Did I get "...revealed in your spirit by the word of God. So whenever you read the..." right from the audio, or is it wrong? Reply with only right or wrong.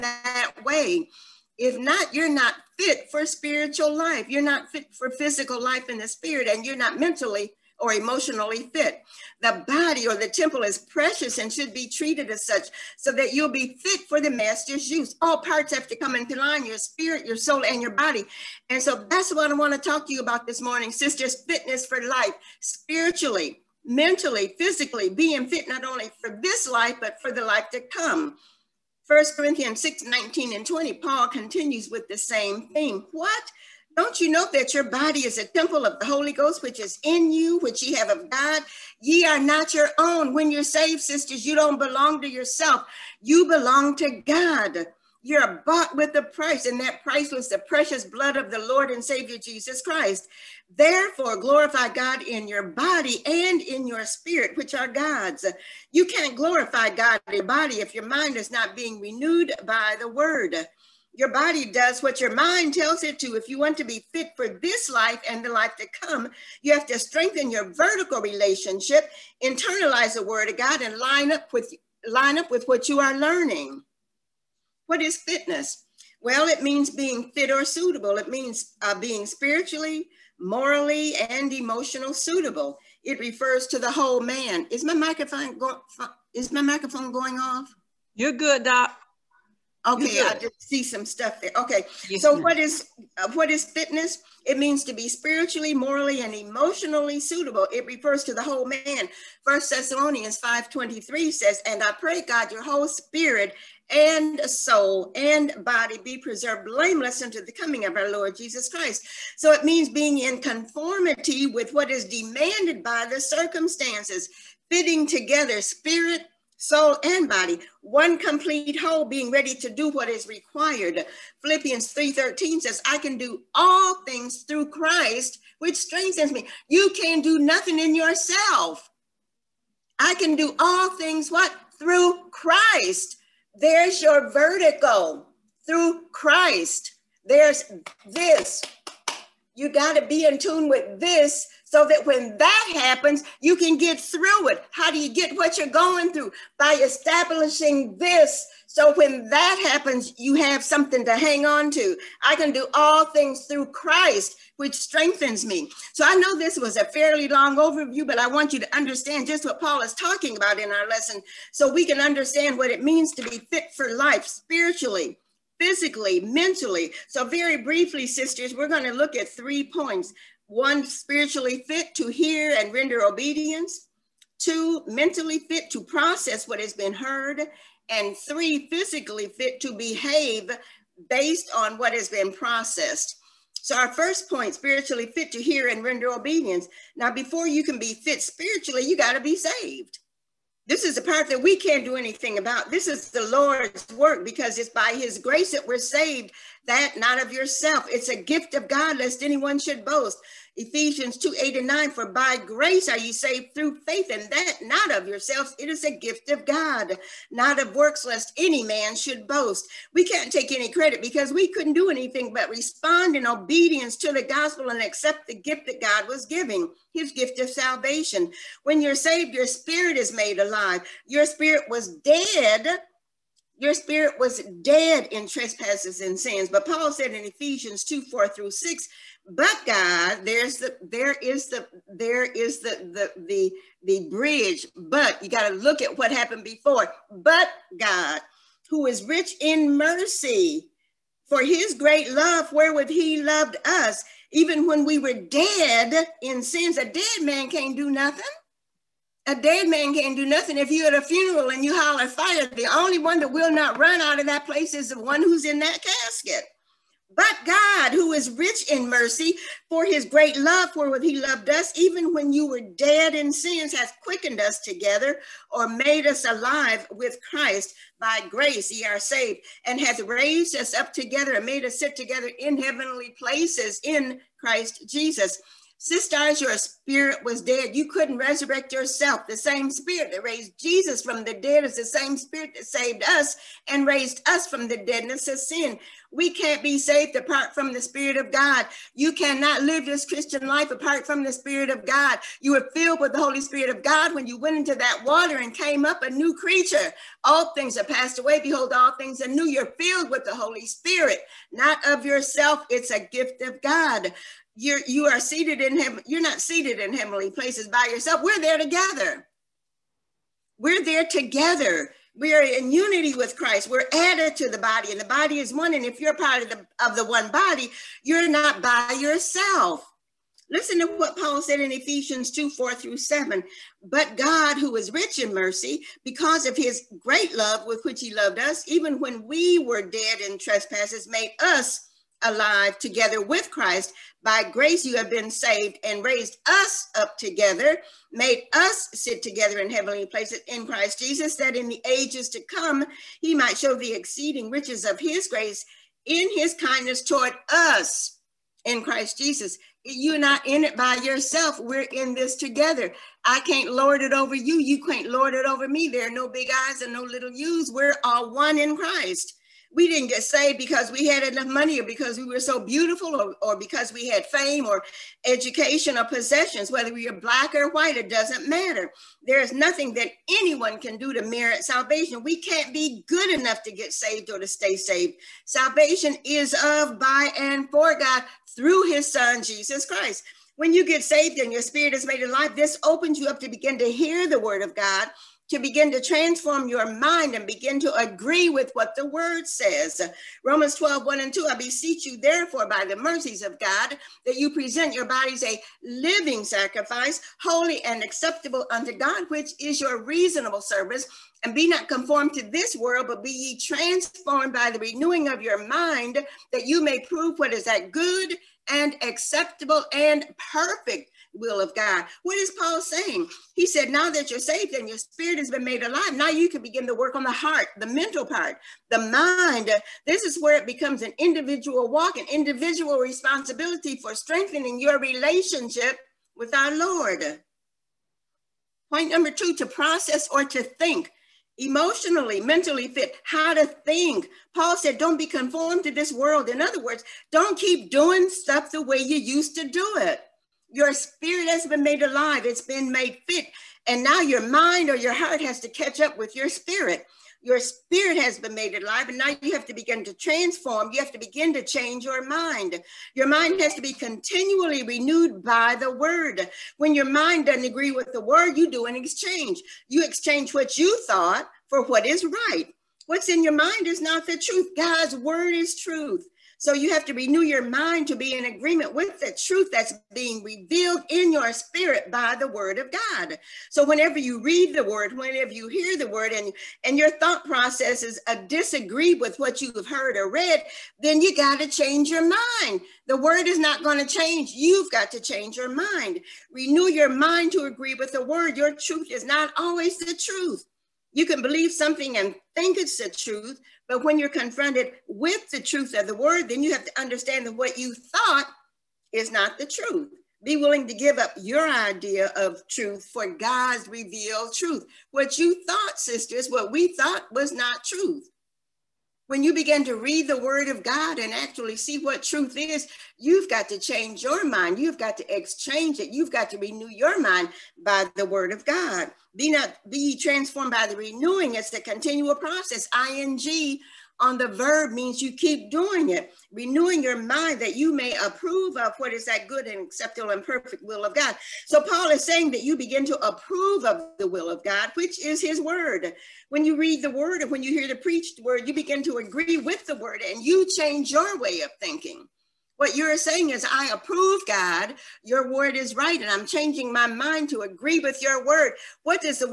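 right.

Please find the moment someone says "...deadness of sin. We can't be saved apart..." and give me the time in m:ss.
4:44.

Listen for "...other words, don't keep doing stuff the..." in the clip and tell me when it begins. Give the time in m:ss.
7:16.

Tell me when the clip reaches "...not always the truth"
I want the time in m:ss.
8:09.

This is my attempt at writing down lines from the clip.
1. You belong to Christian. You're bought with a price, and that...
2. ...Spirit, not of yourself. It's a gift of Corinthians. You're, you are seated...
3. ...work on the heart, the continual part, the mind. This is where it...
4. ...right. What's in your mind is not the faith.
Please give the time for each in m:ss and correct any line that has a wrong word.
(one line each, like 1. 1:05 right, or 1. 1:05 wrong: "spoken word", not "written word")
1. 0:43 wrong: "God", not "Christian"
2. 5:00 wrong: "God", not "Corinthians"
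3. 6:56 wrong: "mental", not "continual"
4. 7:42 wrong: "truth", not "faith".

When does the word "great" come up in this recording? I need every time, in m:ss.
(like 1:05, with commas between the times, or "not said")
4:01, 4:20, 5:26.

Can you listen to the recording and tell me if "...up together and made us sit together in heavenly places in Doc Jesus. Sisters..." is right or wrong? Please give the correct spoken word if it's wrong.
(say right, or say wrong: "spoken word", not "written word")
wrong: "Christ", not "Doc".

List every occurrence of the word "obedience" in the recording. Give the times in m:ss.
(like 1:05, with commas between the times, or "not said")
2:53, 3:06, 3:33.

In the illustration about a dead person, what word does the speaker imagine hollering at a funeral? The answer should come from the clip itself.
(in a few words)
fire.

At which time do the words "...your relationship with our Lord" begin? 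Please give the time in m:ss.
7:04.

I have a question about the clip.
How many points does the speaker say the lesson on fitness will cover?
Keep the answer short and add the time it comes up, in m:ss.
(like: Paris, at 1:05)
3, at 2:49.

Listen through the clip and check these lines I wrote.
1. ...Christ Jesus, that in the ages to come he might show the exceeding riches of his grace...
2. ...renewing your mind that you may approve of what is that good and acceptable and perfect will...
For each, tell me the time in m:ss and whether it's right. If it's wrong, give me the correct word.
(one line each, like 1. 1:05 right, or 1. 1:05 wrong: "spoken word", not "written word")
1. 5:40 right
2. 8:46 right.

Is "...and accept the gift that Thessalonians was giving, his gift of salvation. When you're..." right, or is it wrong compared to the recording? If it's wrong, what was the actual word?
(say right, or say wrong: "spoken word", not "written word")
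wrong: "God", not "Thessalonians".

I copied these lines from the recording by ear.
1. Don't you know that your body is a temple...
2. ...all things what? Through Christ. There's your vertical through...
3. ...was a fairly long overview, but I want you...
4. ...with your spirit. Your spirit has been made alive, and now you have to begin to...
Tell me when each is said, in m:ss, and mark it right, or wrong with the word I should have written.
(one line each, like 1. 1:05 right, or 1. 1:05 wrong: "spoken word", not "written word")
1. 0:33 right
2. 2:10 right
3. 2:36 right
4. 7:26 right.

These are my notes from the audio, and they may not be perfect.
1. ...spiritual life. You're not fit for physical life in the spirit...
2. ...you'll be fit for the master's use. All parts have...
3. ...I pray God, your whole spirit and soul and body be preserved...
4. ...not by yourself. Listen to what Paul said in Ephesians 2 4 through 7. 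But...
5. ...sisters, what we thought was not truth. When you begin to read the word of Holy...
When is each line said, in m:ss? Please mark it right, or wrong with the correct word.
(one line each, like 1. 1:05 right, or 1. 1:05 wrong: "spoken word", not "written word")
1. 0:03 right
2. 0:13 right
3. 1:41 right
4. 5:18 right
5. 8:25 wrong: "God", not "Holy".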